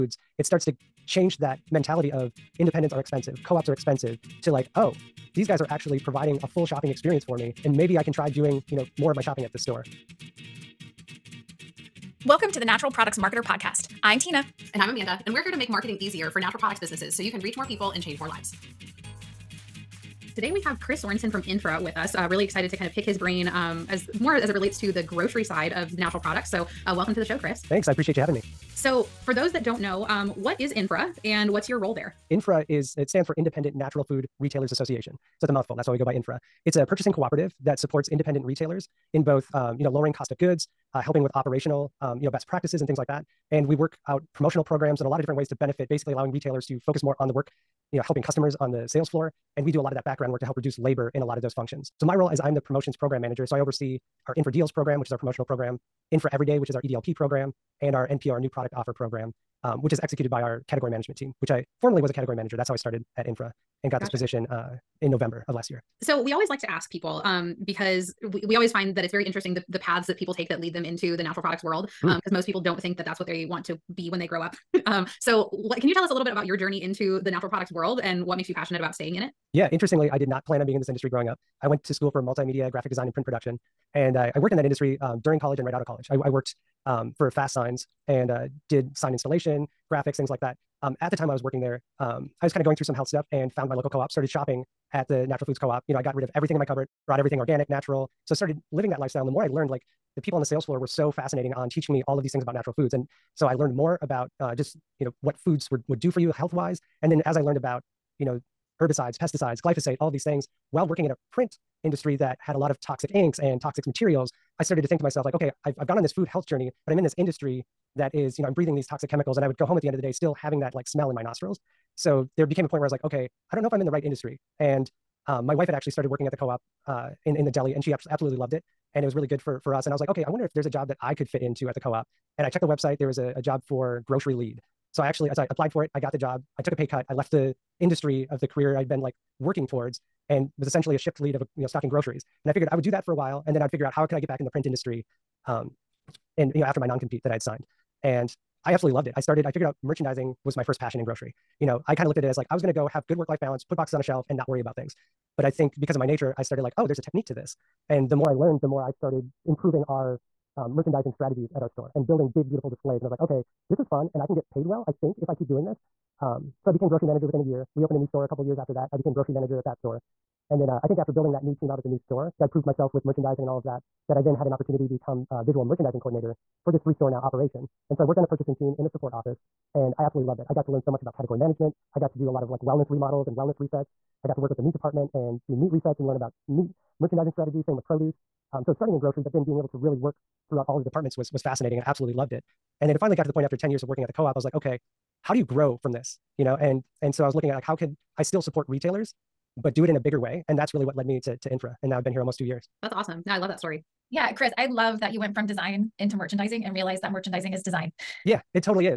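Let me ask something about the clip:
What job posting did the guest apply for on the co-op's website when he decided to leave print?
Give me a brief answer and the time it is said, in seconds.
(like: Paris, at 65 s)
Grocery lead, at 134 s.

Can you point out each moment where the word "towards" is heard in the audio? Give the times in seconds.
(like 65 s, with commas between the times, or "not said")
139 s.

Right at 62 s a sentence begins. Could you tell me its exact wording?
That's how I started at Infra and got gotcha.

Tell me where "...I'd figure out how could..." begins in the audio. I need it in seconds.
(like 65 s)
143 s.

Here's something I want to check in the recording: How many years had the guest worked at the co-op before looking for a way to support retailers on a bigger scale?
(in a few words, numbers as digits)
10.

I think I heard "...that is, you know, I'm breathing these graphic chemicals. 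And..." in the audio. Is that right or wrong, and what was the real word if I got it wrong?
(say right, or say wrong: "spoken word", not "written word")
wrong: "toxic", not "graphic".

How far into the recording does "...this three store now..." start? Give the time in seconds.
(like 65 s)
176 s.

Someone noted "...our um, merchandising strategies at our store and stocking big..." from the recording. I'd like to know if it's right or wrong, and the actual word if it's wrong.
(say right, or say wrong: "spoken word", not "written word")
wrong: "building", not "stocking".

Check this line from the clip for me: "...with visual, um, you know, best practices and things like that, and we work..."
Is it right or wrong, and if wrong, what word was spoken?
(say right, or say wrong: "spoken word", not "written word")
wrong: "operational", not "visual".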